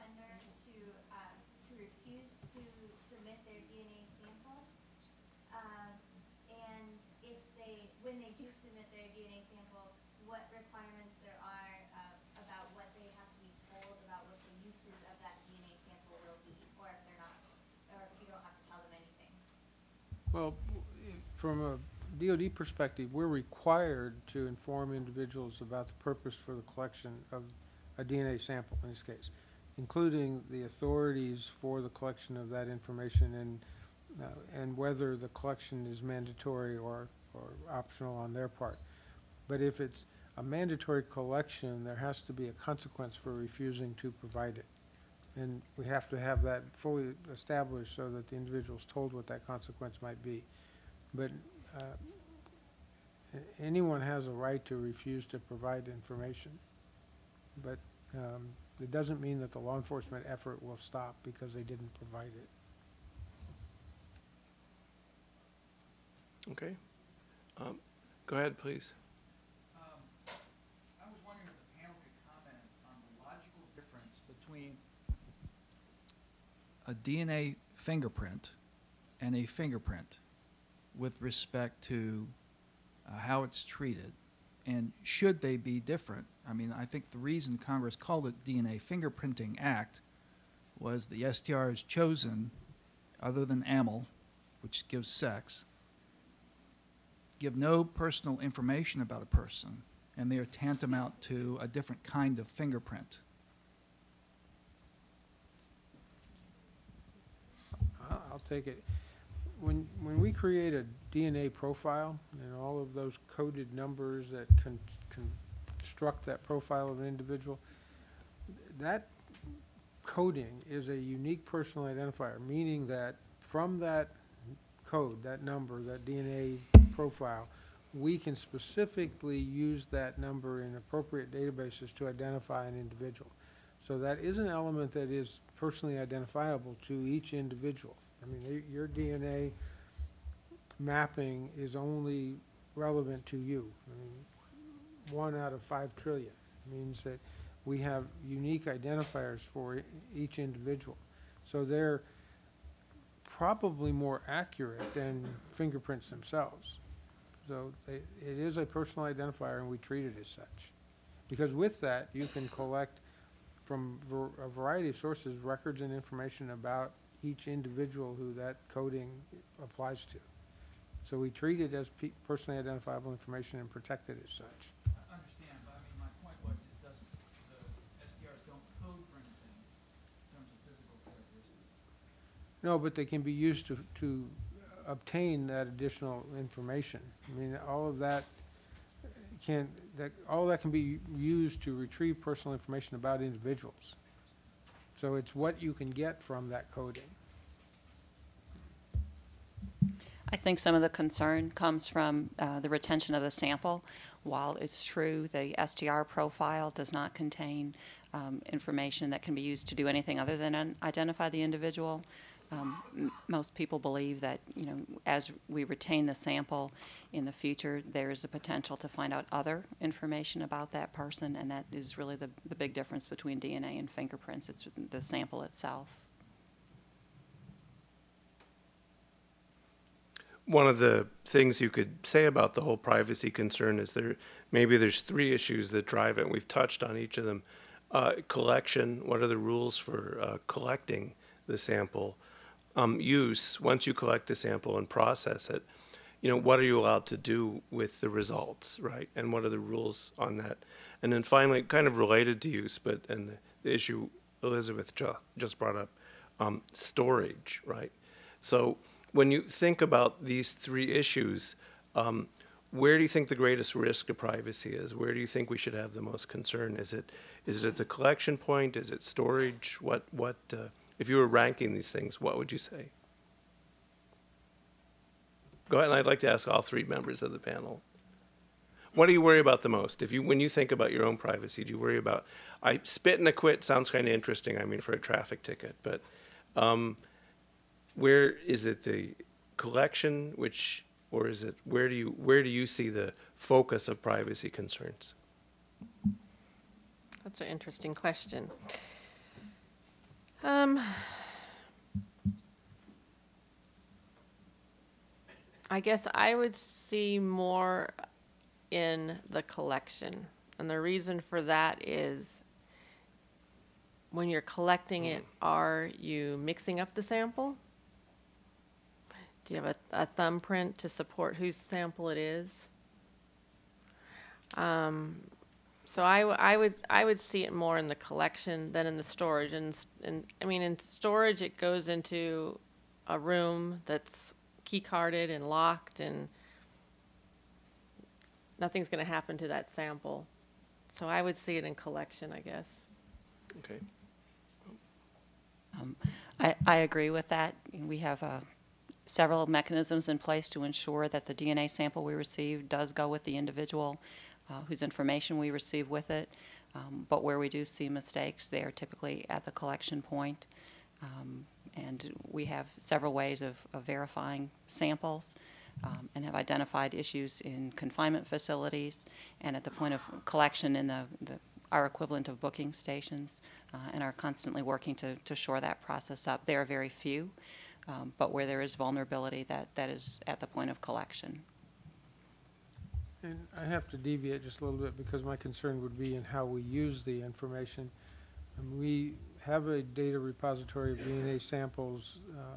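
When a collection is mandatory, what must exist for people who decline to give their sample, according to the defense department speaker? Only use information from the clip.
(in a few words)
a consequence.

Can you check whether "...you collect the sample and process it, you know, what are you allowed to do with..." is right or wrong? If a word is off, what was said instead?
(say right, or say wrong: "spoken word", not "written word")
right.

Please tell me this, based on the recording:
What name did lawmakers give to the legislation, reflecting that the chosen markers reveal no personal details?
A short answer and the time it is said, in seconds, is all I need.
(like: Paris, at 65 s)
DNA Fingerprinting Act, at 88 s.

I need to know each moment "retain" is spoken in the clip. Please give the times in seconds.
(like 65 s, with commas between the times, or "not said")
215 s.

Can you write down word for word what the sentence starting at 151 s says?
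So they're probably more accurate than fingerprints themselves.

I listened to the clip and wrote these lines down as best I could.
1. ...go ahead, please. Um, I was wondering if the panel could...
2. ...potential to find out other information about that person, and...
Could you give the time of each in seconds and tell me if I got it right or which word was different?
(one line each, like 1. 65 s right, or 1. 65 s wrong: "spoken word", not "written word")
1. 68 s right
2. 218 s right.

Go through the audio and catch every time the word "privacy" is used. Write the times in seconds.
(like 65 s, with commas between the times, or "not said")
232 s, 264 s, 281 s, 294 s.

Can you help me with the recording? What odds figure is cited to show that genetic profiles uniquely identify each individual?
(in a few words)
one out of five trillion.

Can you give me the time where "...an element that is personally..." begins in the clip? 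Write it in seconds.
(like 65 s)
134 s.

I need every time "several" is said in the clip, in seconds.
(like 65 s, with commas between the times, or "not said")
349 s, 362 s.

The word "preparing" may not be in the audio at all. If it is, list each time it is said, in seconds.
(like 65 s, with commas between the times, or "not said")
not said.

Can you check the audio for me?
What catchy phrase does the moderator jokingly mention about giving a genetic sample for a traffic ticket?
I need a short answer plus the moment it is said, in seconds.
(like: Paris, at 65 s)
spit and acquit, at 282 s.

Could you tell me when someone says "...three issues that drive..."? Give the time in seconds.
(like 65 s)
234 s.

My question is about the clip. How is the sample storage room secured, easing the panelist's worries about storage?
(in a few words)
key carded and locked.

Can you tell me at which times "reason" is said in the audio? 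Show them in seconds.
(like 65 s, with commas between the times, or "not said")
87 s, 310 s.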